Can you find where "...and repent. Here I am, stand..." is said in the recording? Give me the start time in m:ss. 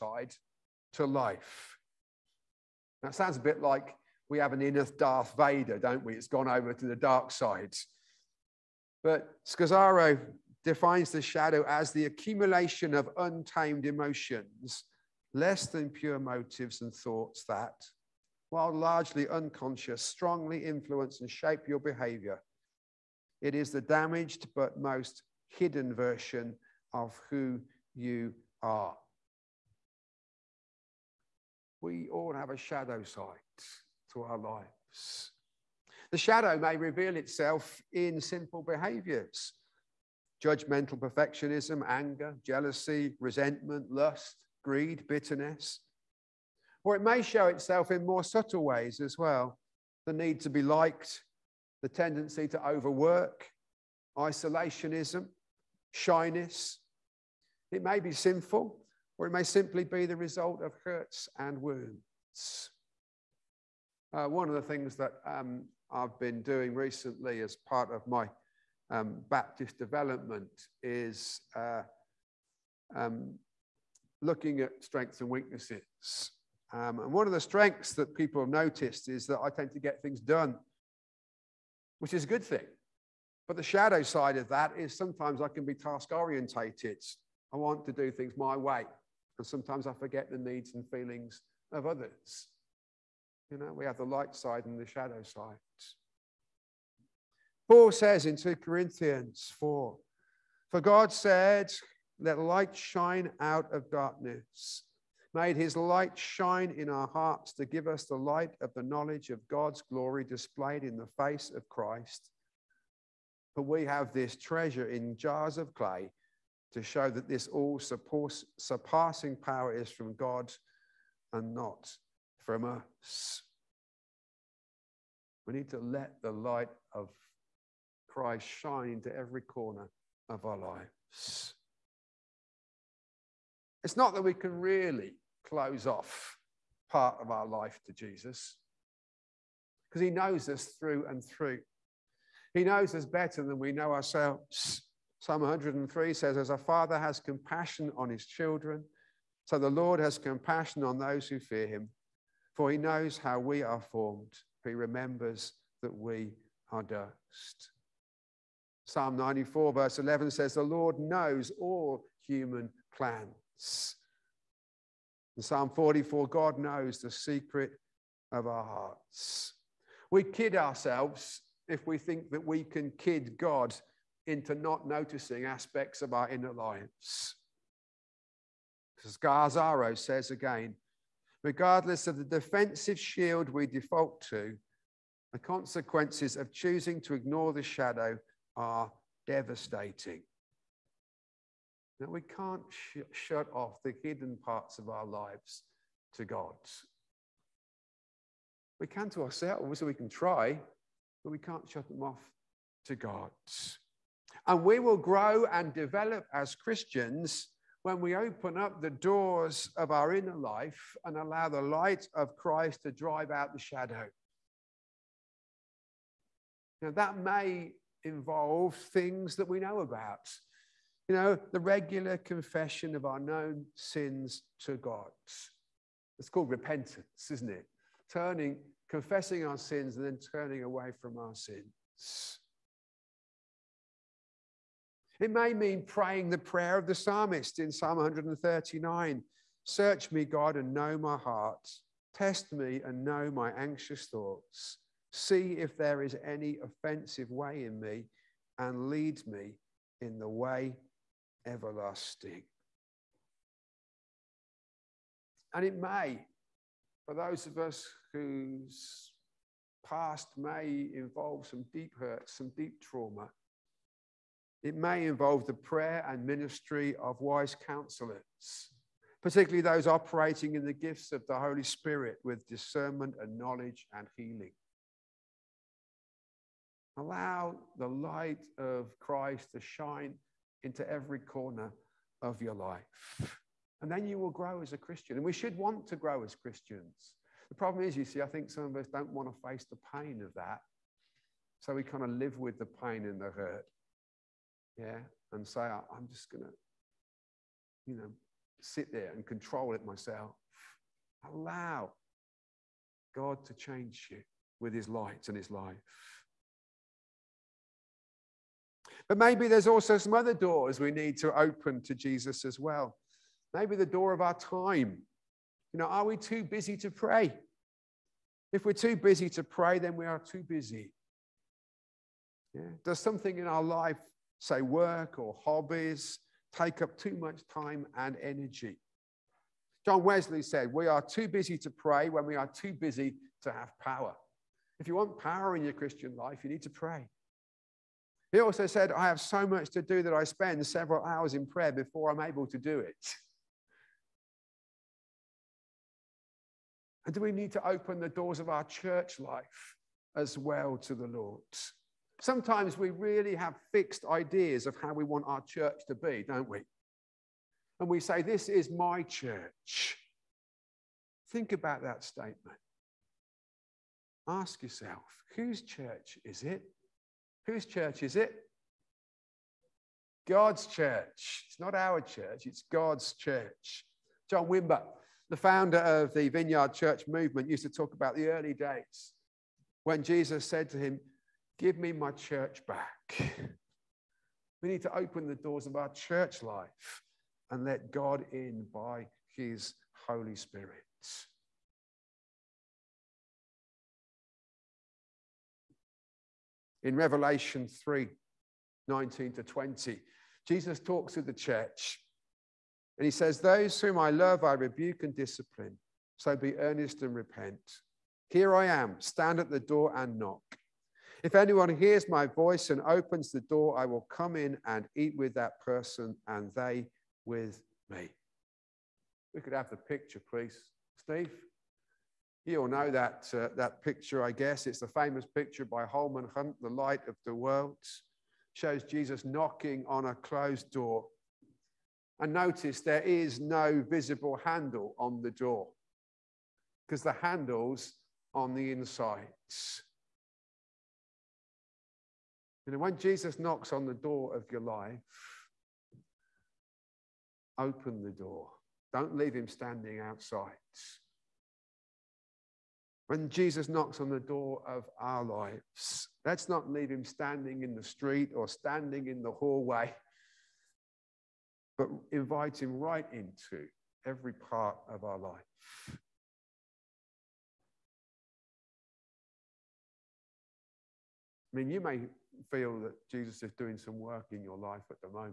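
6:47.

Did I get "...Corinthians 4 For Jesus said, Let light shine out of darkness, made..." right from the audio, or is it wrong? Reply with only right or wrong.
wrong.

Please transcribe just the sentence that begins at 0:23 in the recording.
It is the damaged but most hidden version of who you are.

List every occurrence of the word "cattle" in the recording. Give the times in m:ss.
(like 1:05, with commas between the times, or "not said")
not said.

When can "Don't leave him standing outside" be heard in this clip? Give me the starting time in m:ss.
7:28.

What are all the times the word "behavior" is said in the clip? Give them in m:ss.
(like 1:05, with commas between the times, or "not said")
0:21, 0:38.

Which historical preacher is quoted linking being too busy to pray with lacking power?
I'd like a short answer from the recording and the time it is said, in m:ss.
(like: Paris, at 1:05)
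John Wesley, at 5:29.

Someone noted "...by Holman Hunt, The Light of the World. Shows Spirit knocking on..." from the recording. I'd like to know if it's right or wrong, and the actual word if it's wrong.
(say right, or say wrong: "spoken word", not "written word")
wrong: "Jesus", not "Spirit".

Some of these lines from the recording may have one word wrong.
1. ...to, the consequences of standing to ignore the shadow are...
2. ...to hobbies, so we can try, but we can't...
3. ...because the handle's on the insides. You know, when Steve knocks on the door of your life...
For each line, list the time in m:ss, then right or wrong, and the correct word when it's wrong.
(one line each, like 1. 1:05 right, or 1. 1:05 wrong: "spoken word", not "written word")
1. 3:04 wrong: "choosing", not "standing"
2. 3:19 wrong: "ourselves", not "hobbies"
3. 7:16 wrong: "Jesus", not "Steve".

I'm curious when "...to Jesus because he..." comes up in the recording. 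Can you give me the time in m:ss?
2:17.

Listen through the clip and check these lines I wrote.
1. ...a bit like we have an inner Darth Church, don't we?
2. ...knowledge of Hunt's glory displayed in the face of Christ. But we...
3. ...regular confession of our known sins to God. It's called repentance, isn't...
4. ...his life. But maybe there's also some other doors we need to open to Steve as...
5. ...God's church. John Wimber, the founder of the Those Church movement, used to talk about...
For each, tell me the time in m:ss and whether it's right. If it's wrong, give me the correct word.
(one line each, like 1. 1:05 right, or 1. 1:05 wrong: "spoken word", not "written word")
1. 0:03 wrong: "Vader", not "Church"
2. 1:48 wrong: "God", not "Hunt"
3. 3:41 right
4. 5:05 wrong: "Jesus", not "Steve"
5. 6:12 wrong: "Vineyard", not "Those".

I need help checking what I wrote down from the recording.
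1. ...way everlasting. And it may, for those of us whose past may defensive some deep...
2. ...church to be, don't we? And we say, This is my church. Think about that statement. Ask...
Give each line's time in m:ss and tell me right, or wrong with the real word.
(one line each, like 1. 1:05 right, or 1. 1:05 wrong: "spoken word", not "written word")
1. 4:10 wrong: "involve", not "defensive"
2. 5:55 right.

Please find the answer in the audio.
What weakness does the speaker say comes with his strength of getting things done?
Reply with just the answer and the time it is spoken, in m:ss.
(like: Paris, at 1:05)
task orientated, at 1:25.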